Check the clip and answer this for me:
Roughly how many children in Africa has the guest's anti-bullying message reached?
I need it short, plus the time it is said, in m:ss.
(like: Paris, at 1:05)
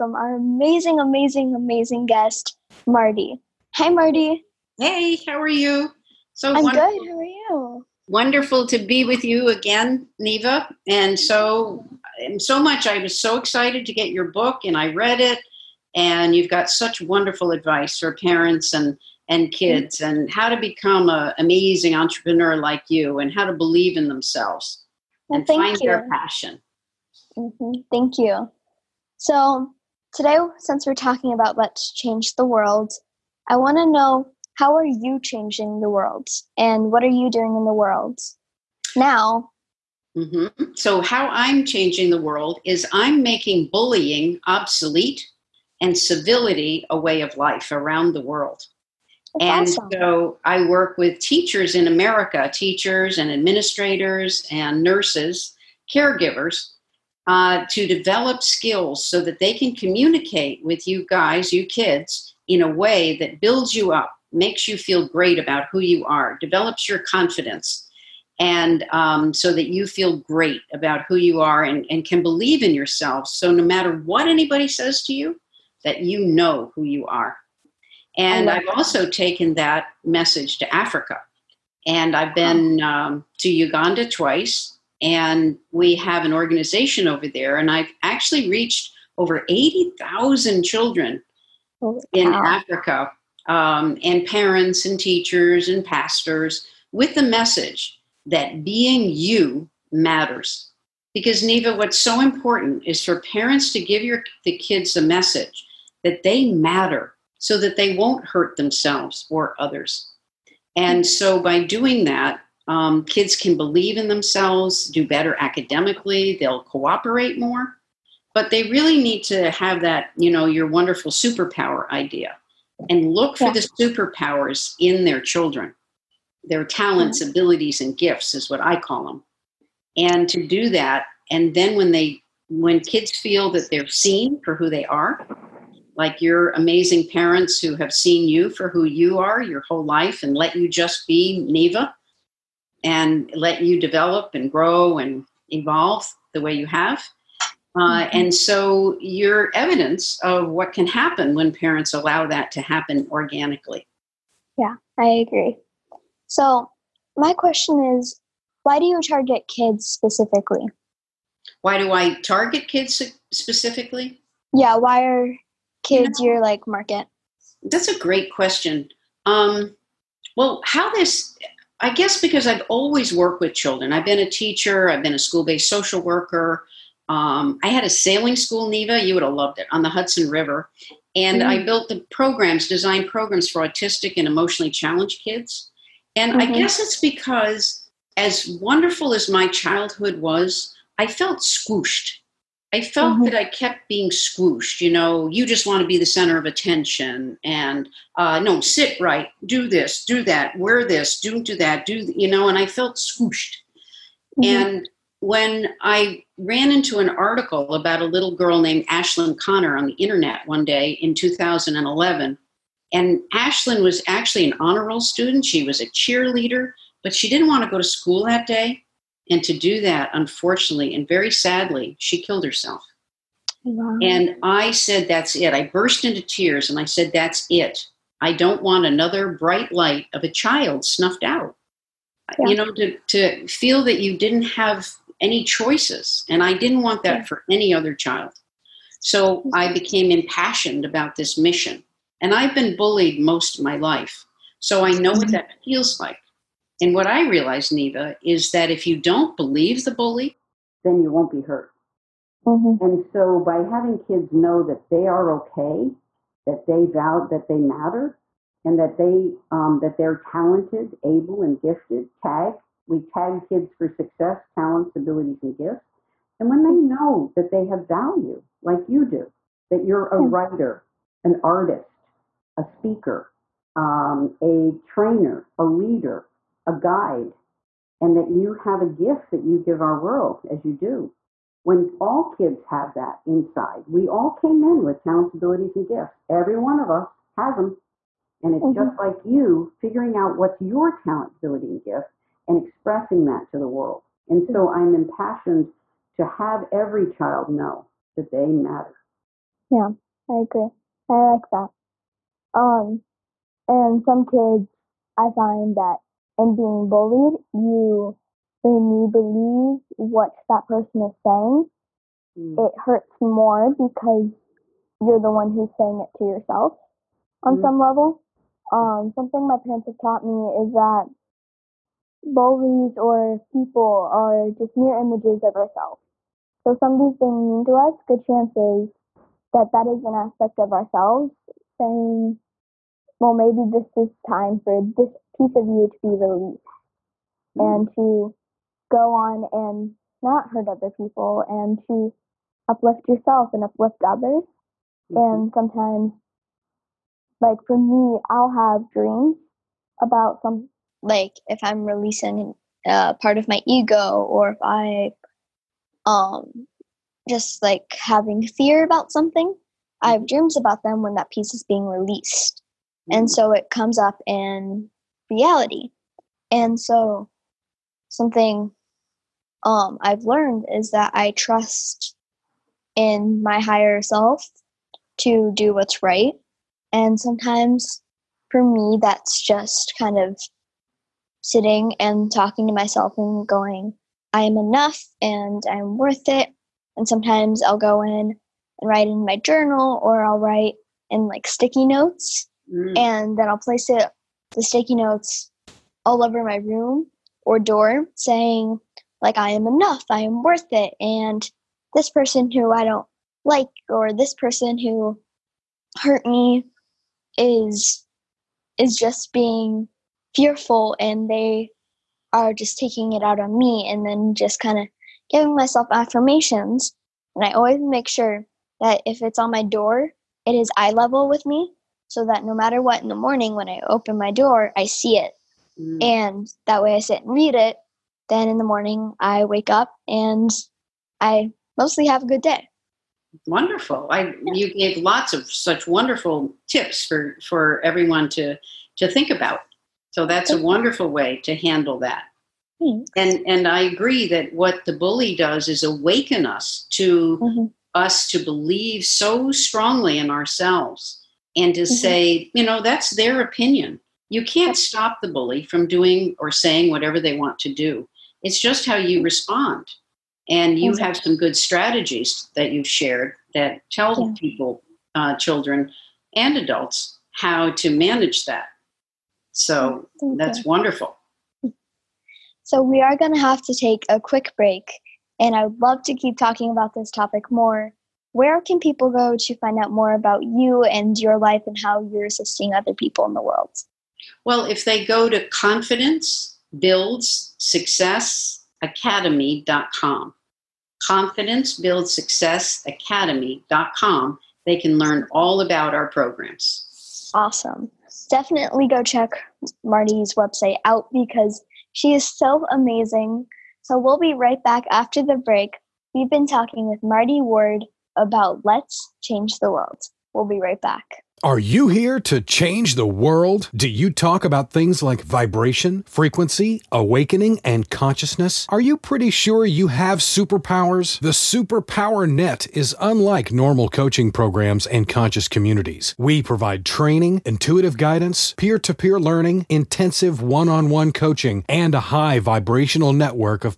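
80,000, at 1:29.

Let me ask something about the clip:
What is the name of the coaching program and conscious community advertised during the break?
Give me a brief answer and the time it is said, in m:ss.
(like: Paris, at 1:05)
The Superpower Net, at 8:41.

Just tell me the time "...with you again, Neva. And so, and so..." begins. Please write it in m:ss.
0:09.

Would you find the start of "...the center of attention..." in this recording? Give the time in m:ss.
3:15.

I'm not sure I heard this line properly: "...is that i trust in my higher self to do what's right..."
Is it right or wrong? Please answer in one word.
right.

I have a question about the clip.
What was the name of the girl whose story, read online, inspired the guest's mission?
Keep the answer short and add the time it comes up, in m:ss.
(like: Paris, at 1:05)
Ashlynn Conner, at 3:28.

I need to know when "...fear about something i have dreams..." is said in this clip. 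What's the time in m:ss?
5:58.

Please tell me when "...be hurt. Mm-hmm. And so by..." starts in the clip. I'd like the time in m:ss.
4:11.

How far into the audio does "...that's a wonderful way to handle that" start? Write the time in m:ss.
7:20.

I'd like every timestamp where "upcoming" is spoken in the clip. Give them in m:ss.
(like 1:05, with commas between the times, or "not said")
not said.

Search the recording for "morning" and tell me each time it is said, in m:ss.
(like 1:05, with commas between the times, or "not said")
7:03, 7:08.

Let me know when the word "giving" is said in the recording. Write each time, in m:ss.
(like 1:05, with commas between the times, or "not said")
6:55.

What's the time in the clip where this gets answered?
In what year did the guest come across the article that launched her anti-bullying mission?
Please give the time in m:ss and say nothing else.
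3:31.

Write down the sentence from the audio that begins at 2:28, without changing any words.
and so your evidence of what can happen when parents allow that to happen organically.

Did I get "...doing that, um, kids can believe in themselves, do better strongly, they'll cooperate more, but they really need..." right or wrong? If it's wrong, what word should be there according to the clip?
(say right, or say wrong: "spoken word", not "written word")
wrong: "academically", not "strongly".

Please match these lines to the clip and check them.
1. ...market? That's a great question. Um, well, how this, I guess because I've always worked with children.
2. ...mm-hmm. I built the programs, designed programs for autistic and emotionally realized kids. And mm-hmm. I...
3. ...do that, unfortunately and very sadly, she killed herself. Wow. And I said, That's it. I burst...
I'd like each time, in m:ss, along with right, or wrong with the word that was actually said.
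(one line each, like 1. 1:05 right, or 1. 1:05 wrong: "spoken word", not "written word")
1. 2:46 right
2. 3:01 wrong: "challenged", not "realized"
3. 3:39 right.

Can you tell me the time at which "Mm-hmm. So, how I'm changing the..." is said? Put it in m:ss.
0:40.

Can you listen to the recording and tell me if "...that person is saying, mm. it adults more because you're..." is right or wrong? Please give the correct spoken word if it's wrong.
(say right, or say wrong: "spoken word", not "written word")
wrong: "hurts", not "adults".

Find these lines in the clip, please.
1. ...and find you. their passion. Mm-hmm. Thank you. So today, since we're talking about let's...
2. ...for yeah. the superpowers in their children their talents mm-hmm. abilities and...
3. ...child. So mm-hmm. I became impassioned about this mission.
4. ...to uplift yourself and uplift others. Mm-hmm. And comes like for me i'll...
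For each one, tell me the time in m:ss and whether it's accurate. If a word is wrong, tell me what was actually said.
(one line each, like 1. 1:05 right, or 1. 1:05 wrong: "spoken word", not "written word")
1. 0:25 right
2. 2:03 right
3. 3:57 right
4. 5:41 wrong: "sometimes", not "comes".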